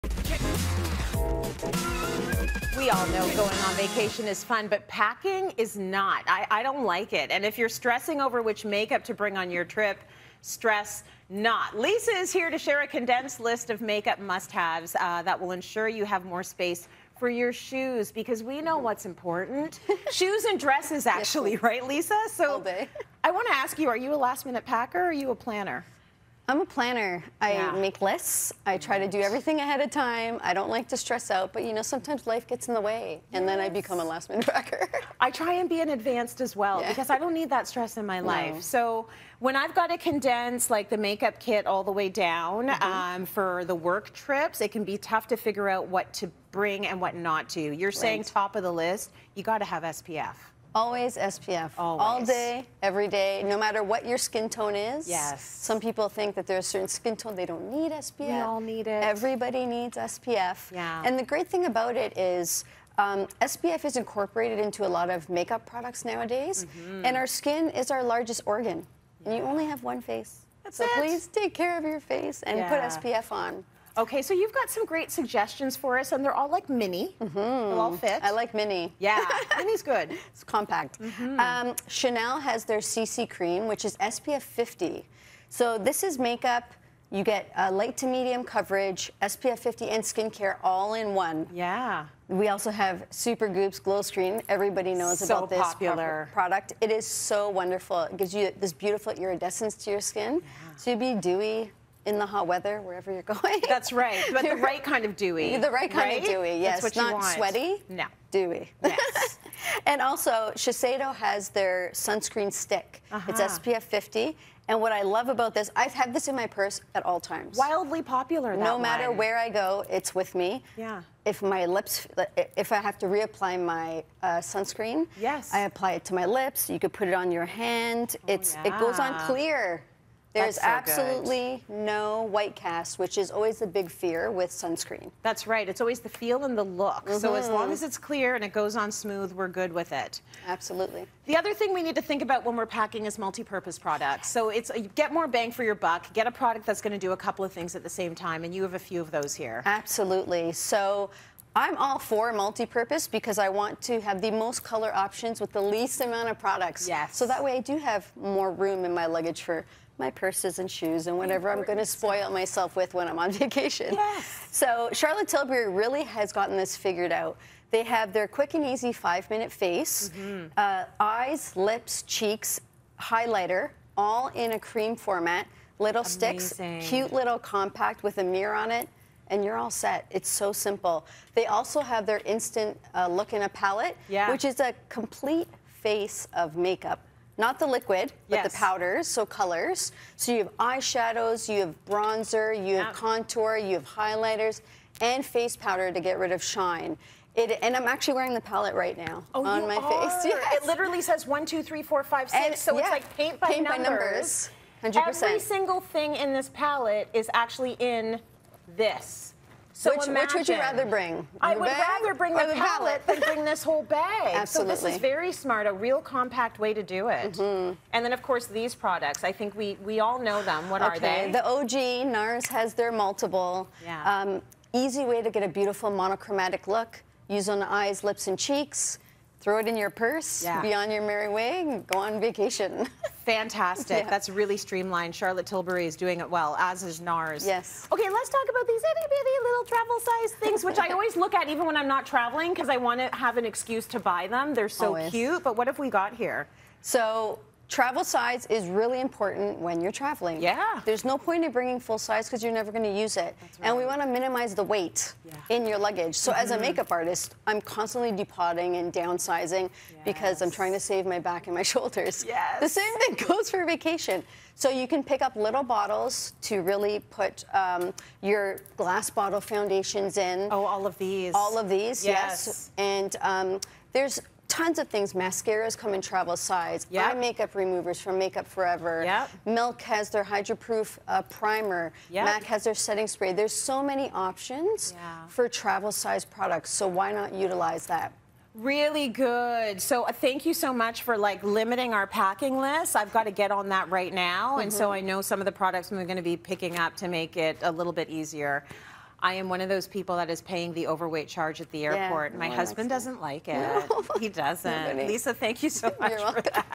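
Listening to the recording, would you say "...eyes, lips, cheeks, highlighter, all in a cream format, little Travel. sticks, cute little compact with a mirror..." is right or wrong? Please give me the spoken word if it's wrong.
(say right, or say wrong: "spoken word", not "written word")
wrong: "Amazing", not "Travel".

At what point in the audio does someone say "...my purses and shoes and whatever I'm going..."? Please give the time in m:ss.
2:40.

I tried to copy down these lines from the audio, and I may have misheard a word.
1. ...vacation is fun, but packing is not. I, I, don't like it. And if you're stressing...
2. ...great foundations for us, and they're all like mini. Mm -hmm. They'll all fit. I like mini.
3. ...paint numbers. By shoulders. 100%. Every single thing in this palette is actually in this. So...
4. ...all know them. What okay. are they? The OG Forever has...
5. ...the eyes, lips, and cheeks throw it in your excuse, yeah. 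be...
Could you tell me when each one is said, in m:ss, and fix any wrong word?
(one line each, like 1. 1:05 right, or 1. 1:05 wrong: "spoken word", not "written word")
1. 0:03 right
2. 1:14 wrong: "suggestions", not "foundations"
3. 3:23 wrong: "numbers", not "shoulders"
4. 3:40 wrong: "NARS", not "Forever"
5. 3:47 wrong: "purse", not "excuse".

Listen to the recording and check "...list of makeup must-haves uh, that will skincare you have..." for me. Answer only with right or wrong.
wrong.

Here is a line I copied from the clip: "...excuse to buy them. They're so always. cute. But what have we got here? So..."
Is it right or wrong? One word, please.
right.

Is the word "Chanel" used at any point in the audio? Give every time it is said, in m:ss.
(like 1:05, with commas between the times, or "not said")
1:21.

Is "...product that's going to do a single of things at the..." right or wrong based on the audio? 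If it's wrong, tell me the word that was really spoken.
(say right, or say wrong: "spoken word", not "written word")
wrong: "couple", not "single".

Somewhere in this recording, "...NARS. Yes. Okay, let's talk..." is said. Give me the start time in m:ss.
3:57.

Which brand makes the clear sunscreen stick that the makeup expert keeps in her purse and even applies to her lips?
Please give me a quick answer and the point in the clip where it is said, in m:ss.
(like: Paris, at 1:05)
Shiseido, at 1:50.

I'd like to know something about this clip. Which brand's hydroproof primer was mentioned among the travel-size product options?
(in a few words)
Milk.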